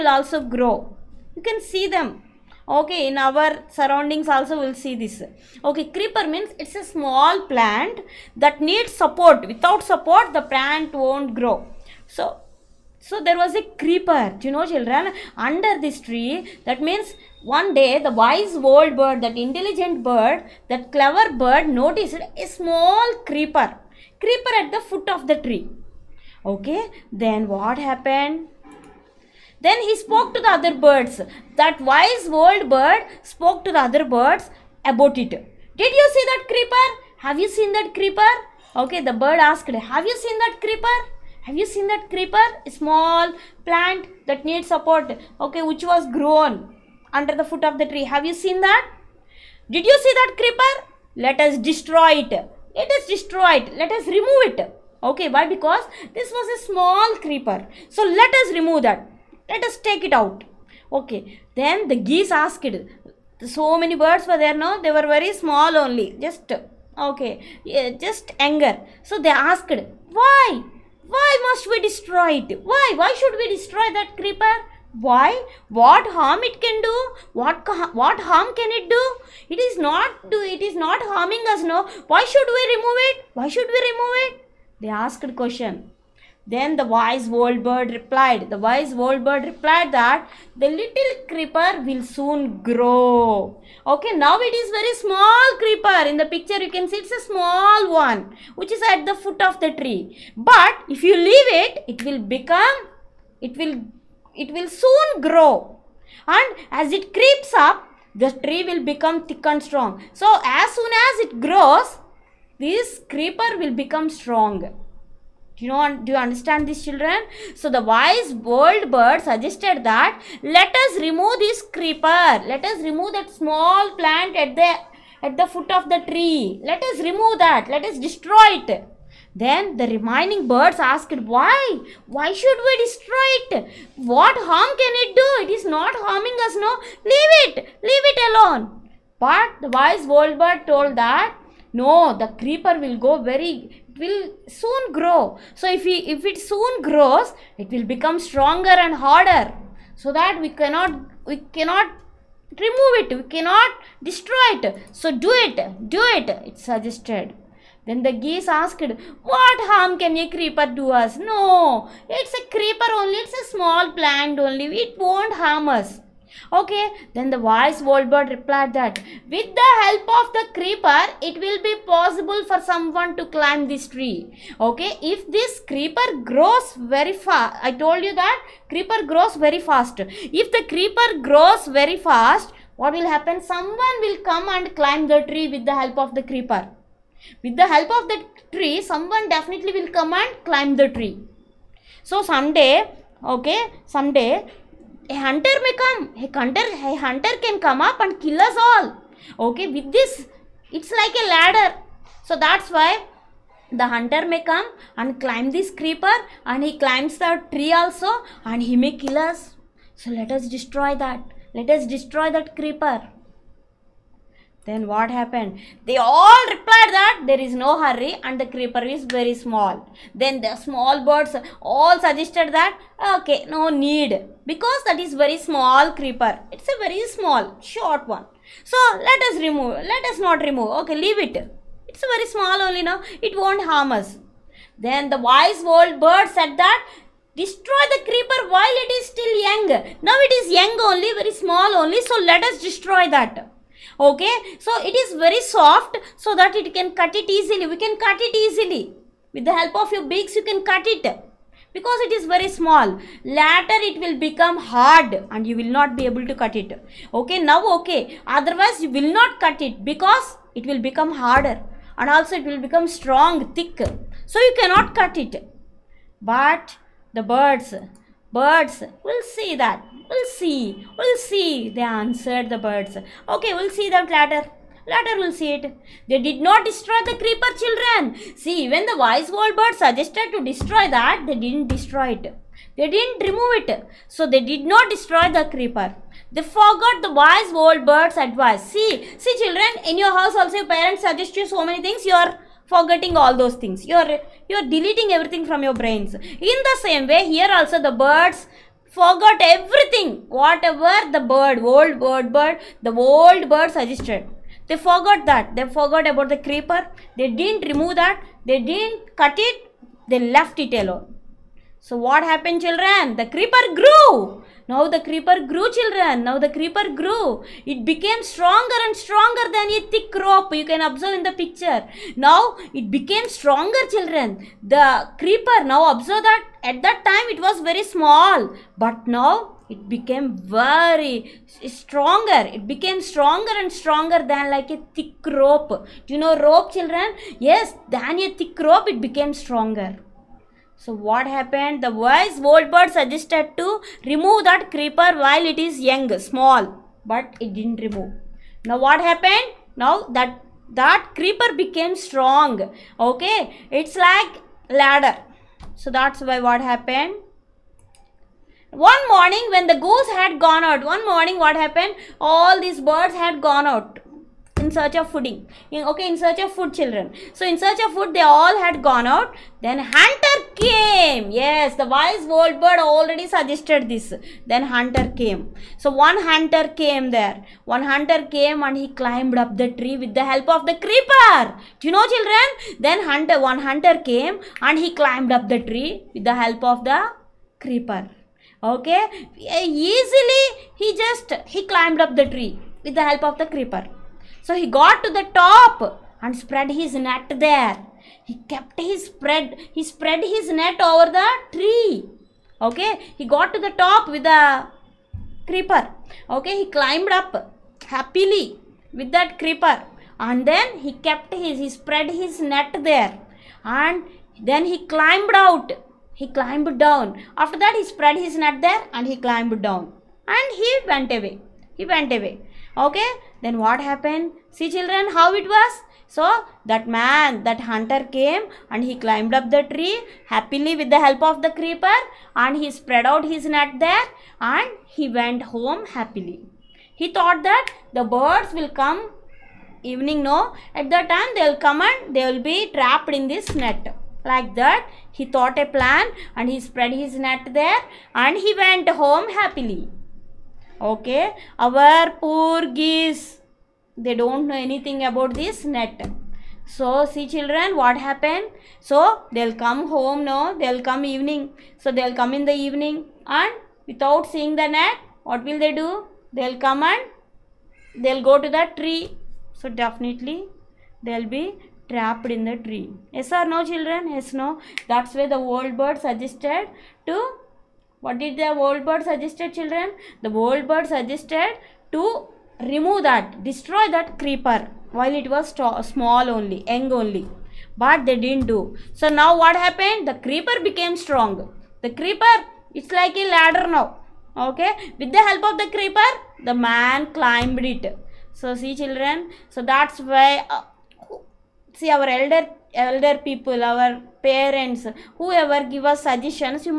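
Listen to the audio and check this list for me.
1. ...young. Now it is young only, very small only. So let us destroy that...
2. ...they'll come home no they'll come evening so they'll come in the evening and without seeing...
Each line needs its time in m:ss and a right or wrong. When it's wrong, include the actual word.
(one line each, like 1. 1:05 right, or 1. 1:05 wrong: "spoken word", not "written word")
1. 3:59 right
2. 7:39 right.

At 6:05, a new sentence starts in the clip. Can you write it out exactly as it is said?
In, okay, in search of food children.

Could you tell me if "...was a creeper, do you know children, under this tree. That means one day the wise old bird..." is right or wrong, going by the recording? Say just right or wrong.
right.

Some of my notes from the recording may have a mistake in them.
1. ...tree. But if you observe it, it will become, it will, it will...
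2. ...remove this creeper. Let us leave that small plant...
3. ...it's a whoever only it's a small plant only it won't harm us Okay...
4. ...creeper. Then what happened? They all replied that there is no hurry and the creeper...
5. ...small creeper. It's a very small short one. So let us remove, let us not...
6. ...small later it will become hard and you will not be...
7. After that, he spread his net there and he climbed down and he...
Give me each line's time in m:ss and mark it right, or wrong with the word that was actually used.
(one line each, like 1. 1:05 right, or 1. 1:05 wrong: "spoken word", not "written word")
1. 1:39 wrong: "leave", not "observe"
2. 2:01 wrong: "remove", not "leave"
3. 2:42 wrong: "creeper", not "whoever"
4. 3:32 right
5. 3:45 right
6. 4:12 right
7. 6:57 right.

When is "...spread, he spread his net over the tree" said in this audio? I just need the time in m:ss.
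6:39.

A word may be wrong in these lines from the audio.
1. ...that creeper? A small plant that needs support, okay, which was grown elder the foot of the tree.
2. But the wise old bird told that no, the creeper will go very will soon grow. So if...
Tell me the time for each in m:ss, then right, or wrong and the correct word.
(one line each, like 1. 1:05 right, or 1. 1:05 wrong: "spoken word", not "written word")
1. 0:41 wrong: "under", not "elder"
2. 2:19 right.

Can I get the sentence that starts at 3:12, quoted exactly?
So someday, okay, someday a hunter may come.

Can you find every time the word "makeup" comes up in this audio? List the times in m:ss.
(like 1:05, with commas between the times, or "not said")
not said.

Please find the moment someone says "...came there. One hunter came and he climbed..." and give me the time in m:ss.
6:16.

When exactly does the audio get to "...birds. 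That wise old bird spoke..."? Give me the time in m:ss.
0:30.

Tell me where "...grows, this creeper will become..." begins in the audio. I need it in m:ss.
1:51.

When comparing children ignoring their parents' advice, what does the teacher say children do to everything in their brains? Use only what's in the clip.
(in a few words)
deleting.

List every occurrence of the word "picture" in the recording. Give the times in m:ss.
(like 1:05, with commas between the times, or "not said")
1:36, 5:21.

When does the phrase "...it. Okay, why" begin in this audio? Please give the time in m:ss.
0:54.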